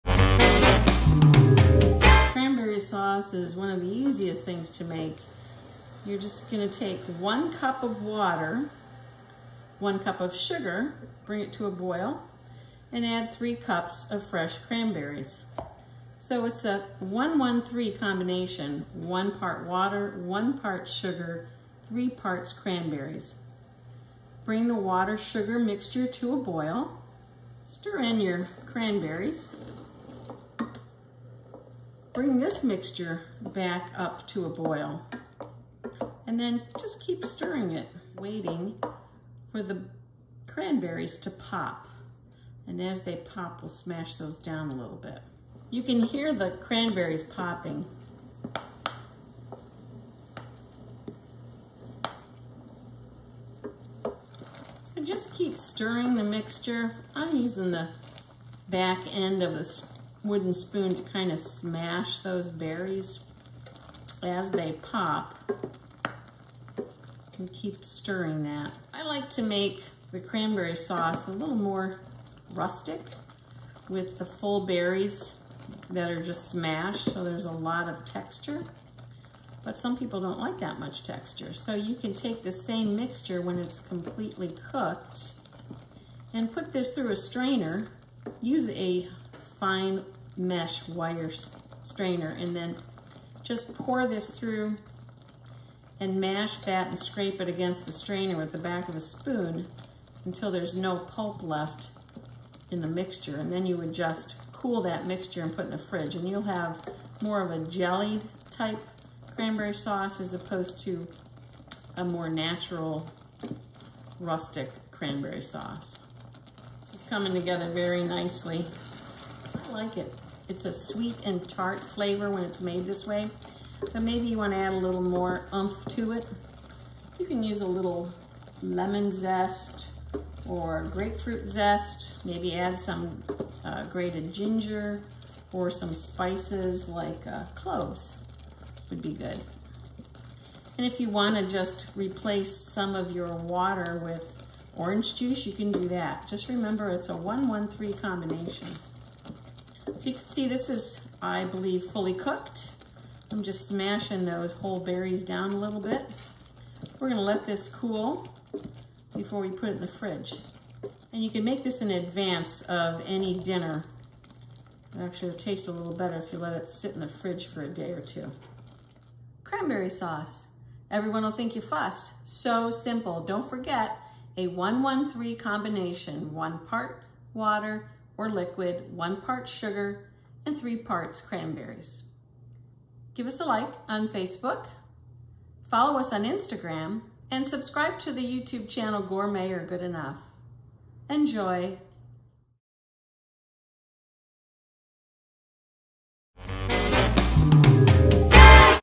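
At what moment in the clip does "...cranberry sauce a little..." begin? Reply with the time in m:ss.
1:10.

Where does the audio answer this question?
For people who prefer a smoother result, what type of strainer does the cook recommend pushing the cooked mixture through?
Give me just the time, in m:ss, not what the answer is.
1:29.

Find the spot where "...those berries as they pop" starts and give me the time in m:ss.
1:02.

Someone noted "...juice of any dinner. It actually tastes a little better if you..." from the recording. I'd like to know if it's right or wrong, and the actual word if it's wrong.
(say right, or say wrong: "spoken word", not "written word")
wrong: "advance", not "juice".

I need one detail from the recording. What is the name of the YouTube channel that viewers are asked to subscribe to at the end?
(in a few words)
Gourmet or Good Enough.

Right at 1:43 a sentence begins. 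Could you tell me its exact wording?
And then you would just cool that mixture and put in the fridge.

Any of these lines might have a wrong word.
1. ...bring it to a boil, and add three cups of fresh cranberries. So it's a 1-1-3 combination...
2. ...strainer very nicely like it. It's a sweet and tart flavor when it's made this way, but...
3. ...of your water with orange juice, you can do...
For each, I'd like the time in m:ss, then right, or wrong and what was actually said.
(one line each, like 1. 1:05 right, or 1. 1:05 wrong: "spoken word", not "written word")
1. 0:11 right
2. 1:57 wrong: "together", not "strainer"
3. 2:22 right.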